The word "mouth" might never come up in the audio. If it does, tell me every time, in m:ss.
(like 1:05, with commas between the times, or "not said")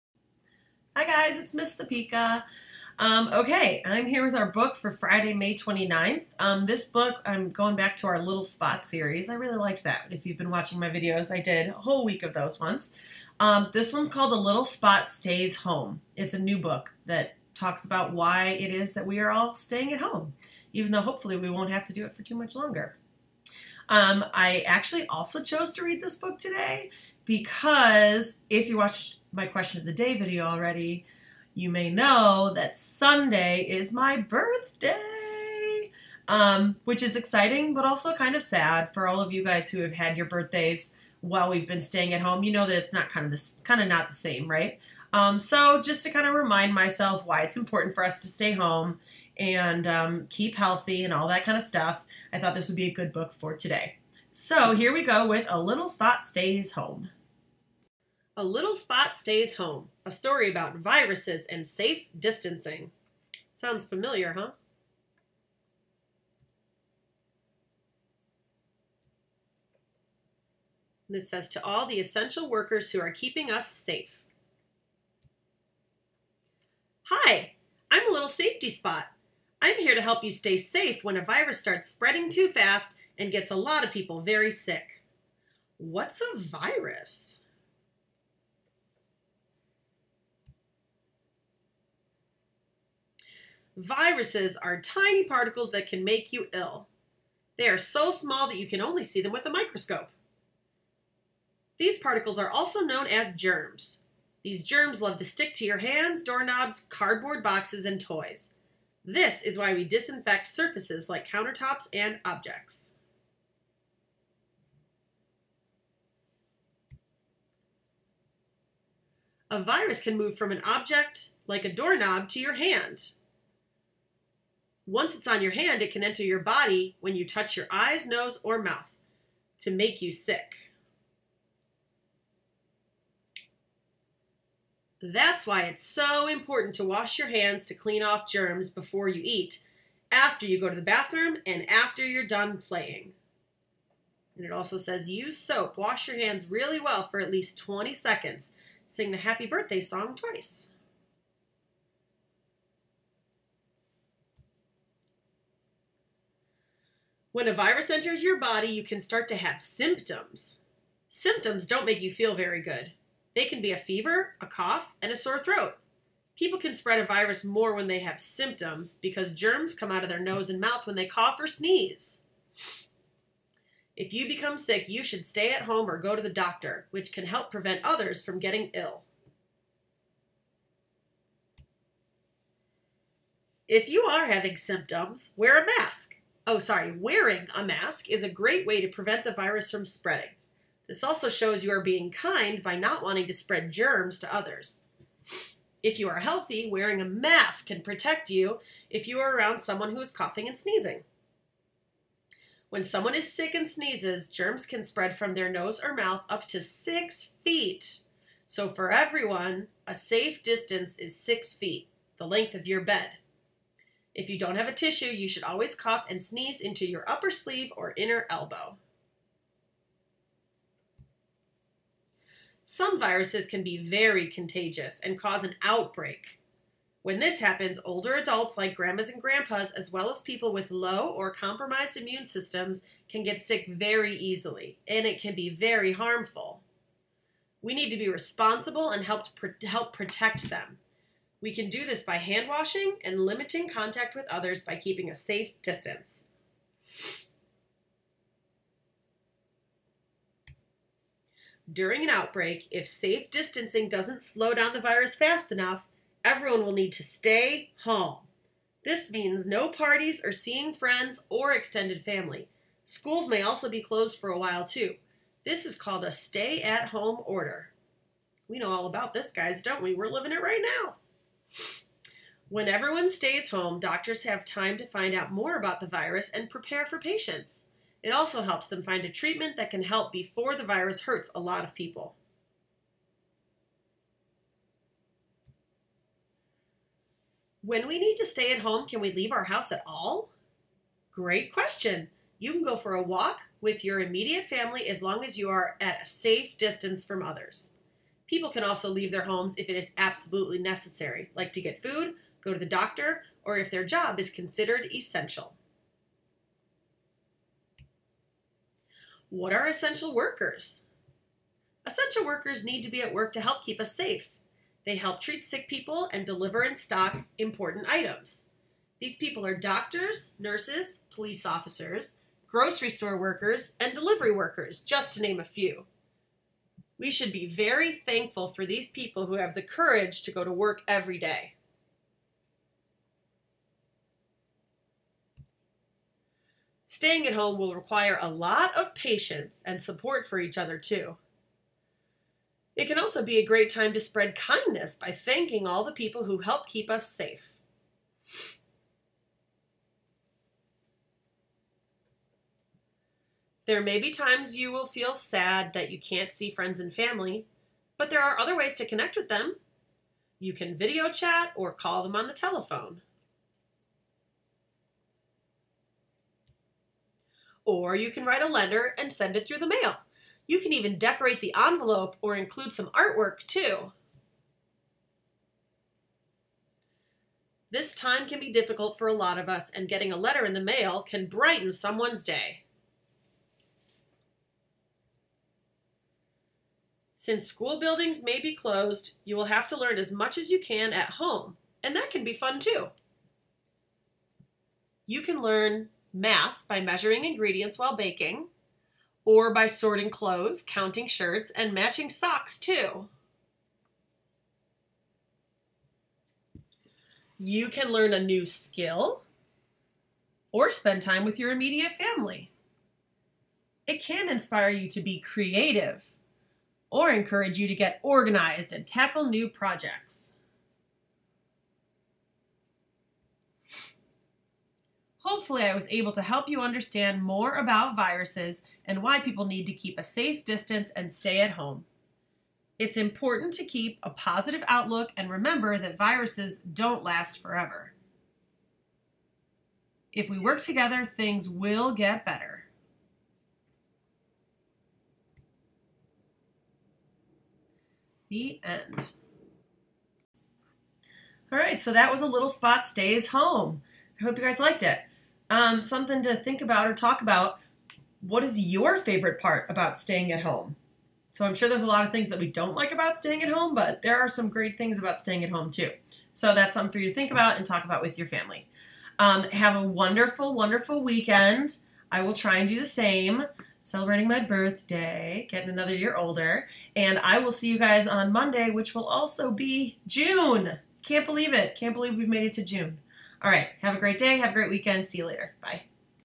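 2:08, 2:50, 3:25.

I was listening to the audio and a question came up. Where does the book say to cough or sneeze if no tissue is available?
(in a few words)
upper sleeve or inner elbow.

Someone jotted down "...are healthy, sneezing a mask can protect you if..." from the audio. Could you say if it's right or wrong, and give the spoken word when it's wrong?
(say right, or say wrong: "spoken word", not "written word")
wrong: "wearing", not "sneezing".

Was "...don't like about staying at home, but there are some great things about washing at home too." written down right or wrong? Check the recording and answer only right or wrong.
wrong.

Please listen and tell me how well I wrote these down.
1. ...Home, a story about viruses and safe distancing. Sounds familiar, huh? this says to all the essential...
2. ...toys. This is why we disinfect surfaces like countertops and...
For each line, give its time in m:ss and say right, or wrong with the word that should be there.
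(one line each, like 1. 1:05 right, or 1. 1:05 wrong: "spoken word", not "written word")
1. 0:59 right
2. 1:48 right.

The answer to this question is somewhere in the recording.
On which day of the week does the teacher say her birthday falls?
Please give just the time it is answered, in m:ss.
0:32.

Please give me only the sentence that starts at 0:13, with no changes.
Um, this one's called The Little Spot Stays Home.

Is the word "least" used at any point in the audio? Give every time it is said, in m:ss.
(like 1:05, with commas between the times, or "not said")
2:27.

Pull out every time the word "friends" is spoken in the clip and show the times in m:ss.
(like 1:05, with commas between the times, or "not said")
4:20, 5:56.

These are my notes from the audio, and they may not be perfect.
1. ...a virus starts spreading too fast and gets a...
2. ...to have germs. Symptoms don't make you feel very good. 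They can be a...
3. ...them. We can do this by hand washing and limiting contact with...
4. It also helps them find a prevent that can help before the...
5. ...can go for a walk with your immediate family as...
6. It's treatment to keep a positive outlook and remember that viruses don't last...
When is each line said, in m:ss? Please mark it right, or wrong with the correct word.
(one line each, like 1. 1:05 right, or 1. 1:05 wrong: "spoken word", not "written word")
1. 1:21 right
2. 2:39 wrong: "symptoms", not "germs"
3. 4:00 right
4. 4:38 wrong: "treatment", not "prevent"
5. 4:52 right
6. 7:12 wrong: "important", not "treatment".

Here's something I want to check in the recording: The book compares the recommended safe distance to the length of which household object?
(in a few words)
your bed.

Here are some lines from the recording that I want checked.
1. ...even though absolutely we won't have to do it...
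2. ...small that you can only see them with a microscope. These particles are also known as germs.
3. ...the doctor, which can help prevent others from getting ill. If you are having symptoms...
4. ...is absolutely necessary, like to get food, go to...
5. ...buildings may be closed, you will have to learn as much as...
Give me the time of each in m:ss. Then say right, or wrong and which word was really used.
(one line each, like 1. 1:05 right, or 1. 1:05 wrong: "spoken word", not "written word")
1. 0:20 wrong: "hopefully", not "absolutely"
2. 1:38 right
3. 2:56 right
4. 4:59 right
5. 6:27 right.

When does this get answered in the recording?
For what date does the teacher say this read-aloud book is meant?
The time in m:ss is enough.
0:04.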